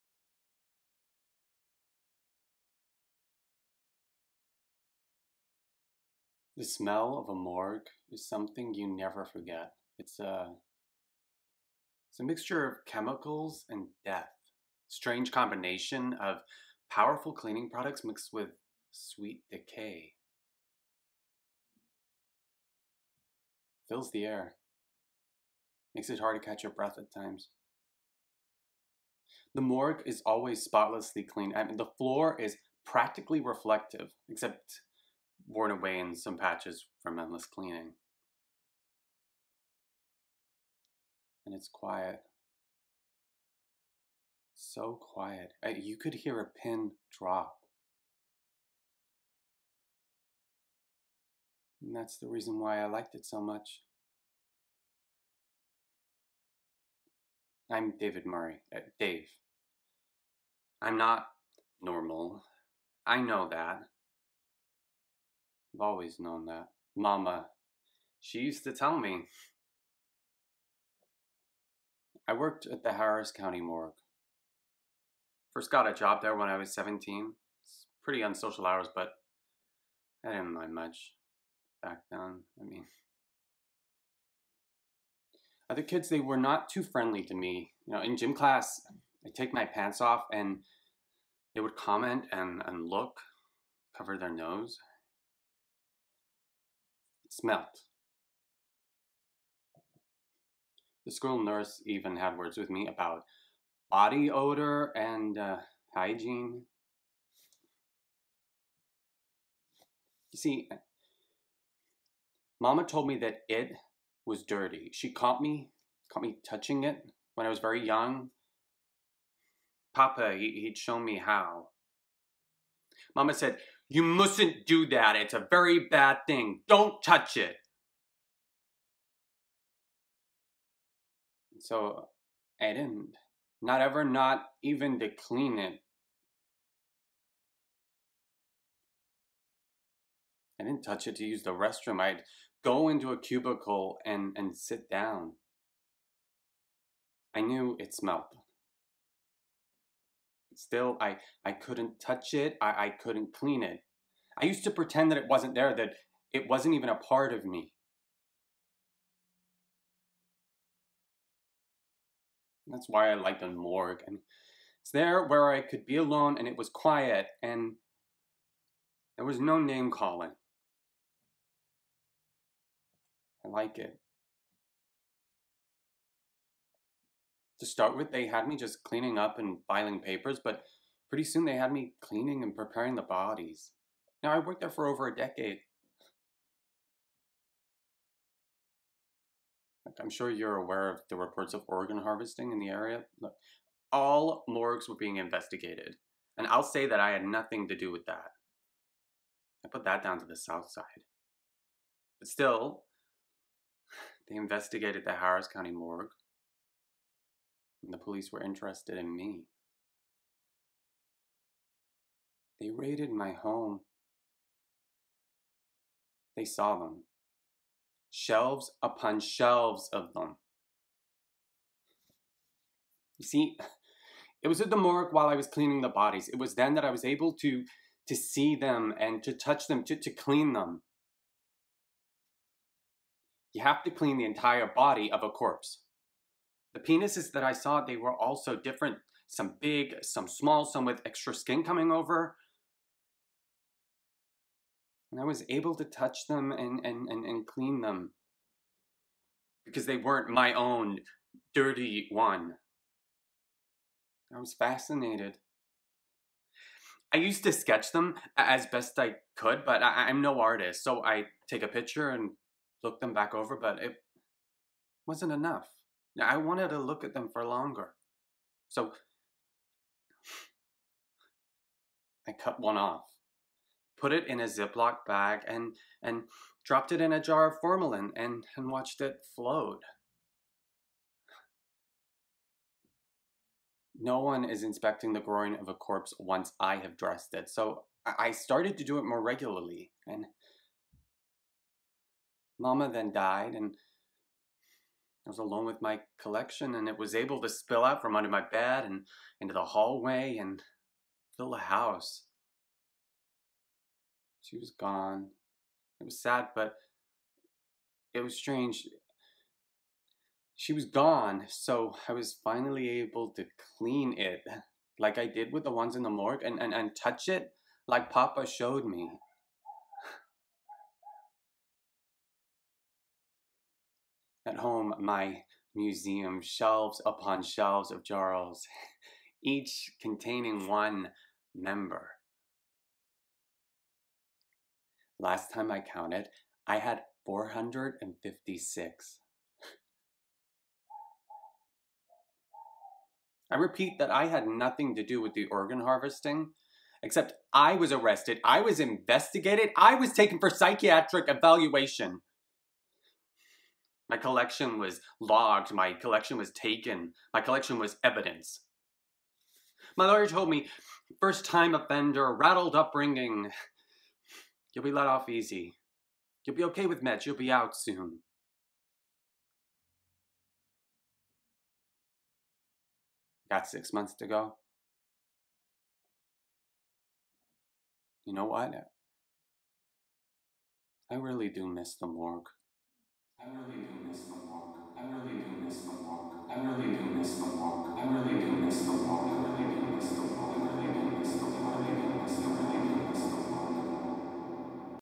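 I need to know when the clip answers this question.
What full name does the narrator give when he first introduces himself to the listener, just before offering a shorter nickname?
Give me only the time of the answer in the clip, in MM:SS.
00:57.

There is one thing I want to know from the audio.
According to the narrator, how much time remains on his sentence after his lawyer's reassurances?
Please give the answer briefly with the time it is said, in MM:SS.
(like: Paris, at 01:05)
6 months, at 06:13.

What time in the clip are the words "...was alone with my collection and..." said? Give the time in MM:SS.
04:55.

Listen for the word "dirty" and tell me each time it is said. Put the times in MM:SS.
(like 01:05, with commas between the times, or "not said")
01:54, 04:11.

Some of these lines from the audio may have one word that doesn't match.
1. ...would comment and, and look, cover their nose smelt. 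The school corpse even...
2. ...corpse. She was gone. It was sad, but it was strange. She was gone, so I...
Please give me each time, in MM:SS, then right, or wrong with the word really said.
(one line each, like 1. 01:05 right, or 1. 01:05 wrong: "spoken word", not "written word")
1. 01:31 wrong: "nurse", not "corpse"
2. 05:01 wrong: "house", not "corpse".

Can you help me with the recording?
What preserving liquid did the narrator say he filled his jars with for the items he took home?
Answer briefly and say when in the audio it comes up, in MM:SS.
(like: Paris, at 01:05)
formalin, at 04:37.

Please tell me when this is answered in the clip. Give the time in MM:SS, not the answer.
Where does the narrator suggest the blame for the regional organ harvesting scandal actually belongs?
03:20.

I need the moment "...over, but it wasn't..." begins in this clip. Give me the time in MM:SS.
04:23.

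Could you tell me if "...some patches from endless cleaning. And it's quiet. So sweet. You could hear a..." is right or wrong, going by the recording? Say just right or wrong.
wrong.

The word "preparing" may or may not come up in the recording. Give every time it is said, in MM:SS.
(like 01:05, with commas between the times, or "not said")
03:02.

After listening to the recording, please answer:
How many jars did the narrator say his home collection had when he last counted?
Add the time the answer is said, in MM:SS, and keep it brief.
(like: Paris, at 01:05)
456, at 05:37.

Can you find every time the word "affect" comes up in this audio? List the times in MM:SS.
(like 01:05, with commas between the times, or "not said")
not said.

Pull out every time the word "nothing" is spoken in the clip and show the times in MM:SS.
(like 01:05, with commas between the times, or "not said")
03:17, 05:44.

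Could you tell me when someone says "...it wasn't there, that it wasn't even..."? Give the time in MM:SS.
02:35.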